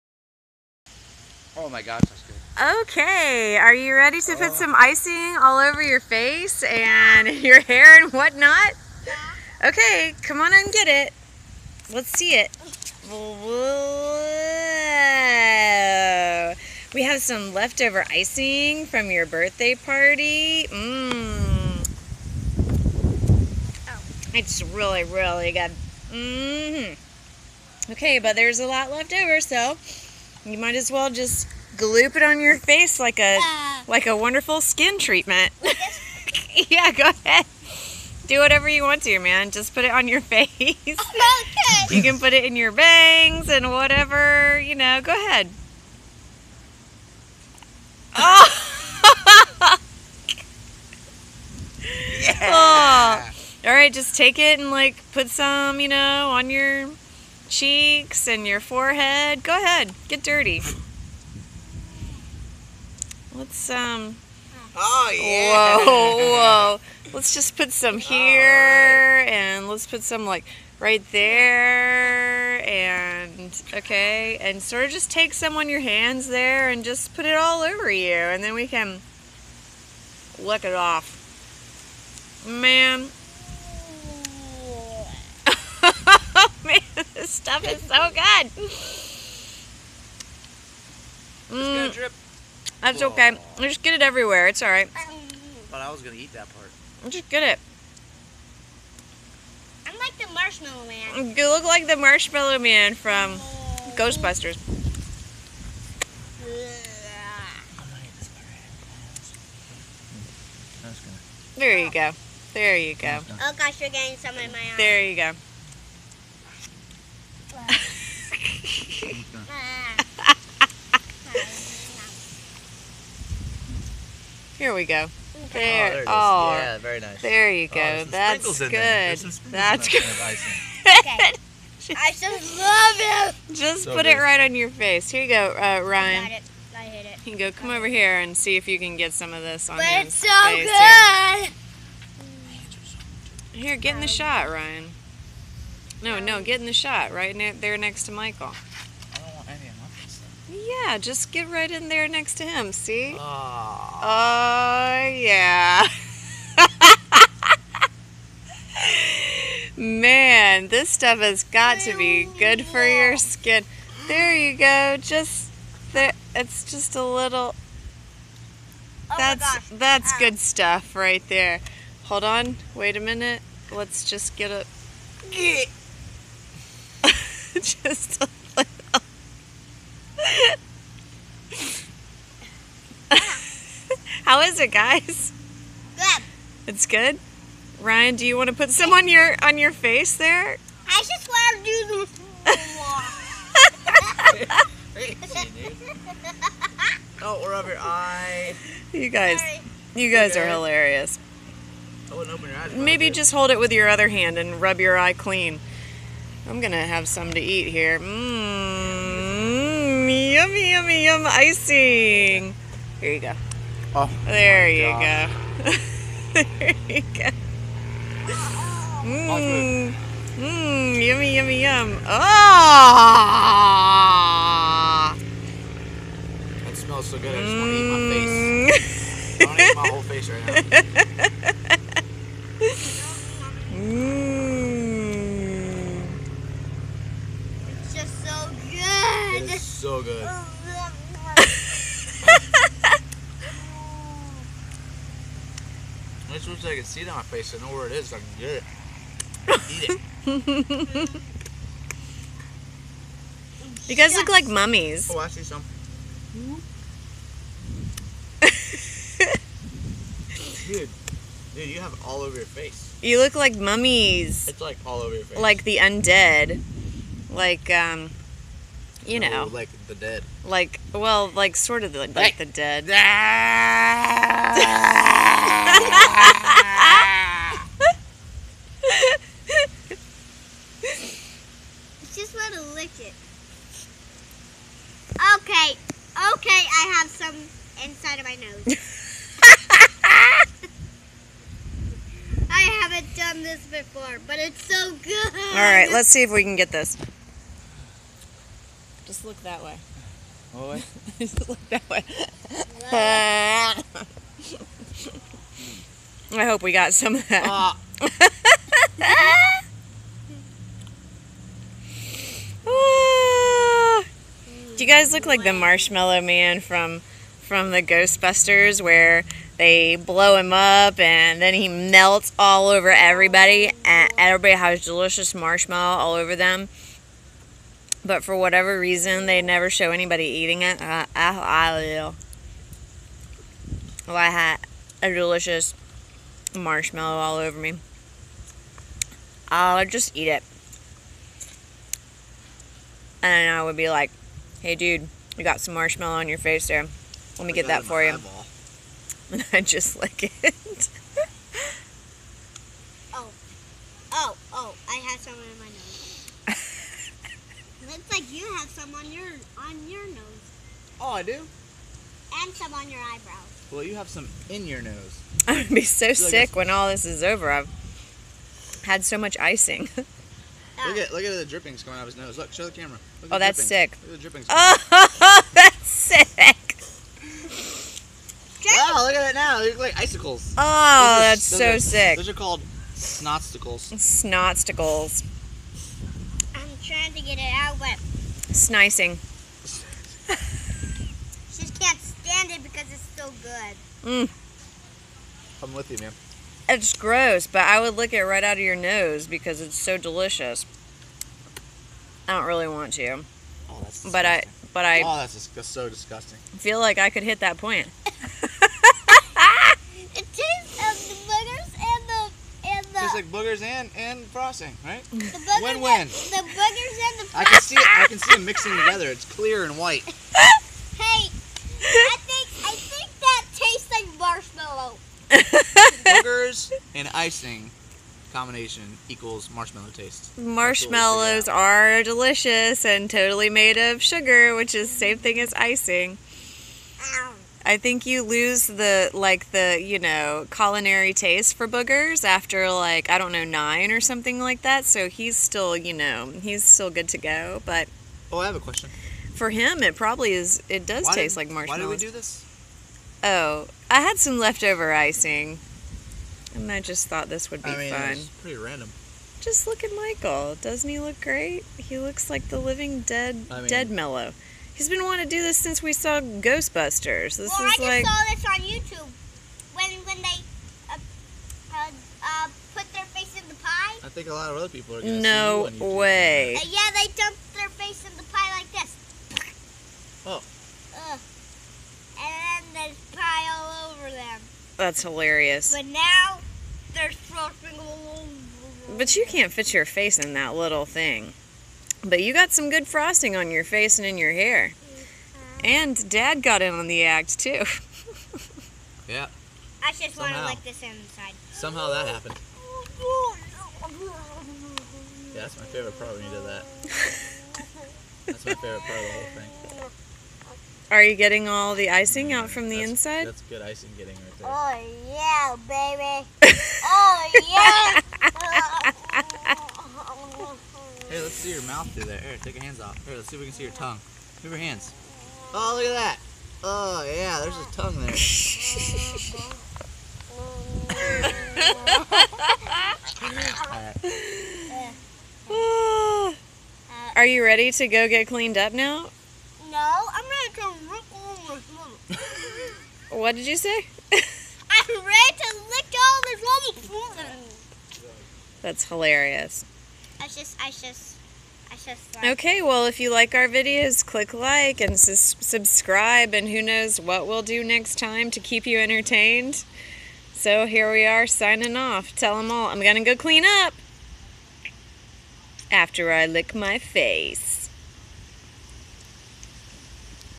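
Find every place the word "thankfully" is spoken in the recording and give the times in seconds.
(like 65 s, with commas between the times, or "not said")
not said.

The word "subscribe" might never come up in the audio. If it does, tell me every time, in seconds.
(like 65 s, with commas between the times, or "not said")
554 s.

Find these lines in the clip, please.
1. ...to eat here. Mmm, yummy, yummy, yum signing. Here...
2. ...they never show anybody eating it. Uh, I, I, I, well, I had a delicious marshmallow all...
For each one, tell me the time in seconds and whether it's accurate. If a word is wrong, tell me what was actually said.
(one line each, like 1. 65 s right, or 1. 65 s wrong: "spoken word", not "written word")
1. 207 s wrong: "icing", not "signing"
2. 329 s right.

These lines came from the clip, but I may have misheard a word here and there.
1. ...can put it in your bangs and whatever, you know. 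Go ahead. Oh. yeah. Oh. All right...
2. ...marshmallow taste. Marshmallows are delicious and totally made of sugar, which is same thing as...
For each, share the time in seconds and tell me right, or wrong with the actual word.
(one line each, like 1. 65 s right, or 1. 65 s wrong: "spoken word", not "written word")
1. 42 s right
2. 429 s right.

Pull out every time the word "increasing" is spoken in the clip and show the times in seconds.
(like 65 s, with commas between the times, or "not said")
not said.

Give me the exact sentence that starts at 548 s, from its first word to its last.
That's hilarious just, I just, I just.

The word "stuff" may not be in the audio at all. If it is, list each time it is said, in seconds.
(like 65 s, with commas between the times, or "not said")
87 s, 160 s, 170 s.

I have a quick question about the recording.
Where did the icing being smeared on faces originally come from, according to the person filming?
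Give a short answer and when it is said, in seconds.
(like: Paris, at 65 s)
Birthday party, at 19 s.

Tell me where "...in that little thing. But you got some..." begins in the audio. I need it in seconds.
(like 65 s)
490 s.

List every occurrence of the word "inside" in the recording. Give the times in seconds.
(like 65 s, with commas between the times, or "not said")
287 s, 500 s, 512 s.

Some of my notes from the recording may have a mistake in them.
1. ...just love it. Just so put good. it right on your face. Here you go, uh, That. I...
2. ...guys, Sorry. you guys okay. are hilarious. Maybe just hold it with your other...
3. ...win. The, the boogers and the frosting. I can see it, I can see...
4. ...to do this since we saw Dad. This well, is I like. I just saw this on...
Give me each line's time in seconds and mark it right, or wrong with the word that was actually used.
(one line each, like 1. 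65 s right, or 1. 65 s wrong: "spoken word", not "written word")
1. 132 s wrong: "Ryan", not "That"
2. 199 s right
3. 415 s right
4. 465 s wrong: "Ghostbusters", not "Dad".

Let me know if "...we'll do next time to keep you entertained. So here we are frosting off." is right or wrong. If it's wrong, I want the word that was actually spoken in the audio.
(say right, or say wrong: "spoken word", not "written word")
wrong: "signing", not "frosting".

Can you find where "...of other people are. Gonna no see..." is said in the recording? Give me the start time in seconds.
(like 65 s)
474 s.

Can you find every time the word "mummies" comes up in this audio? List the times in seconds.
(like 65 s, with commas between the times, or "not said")
254 s, 263 s.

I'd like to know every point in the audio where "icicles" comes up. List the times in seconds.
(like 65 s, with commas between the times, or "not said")
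379 s.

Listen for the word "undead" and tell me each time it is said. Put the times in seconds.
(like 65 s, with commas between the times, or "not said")
265 s.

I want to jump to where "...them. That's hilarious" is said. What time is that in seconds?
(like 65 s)
484 s.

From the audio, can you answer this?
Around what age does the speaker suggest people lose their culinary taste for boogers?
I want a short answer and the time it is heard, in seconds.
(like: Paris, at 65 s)
9, at 443 s.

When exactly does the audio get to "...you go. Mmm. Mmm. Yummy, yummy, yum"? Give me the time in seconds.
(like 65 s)
216 s.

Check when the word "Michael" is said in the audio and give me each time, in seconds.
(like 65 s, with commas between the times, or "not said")
148 s, 459 s.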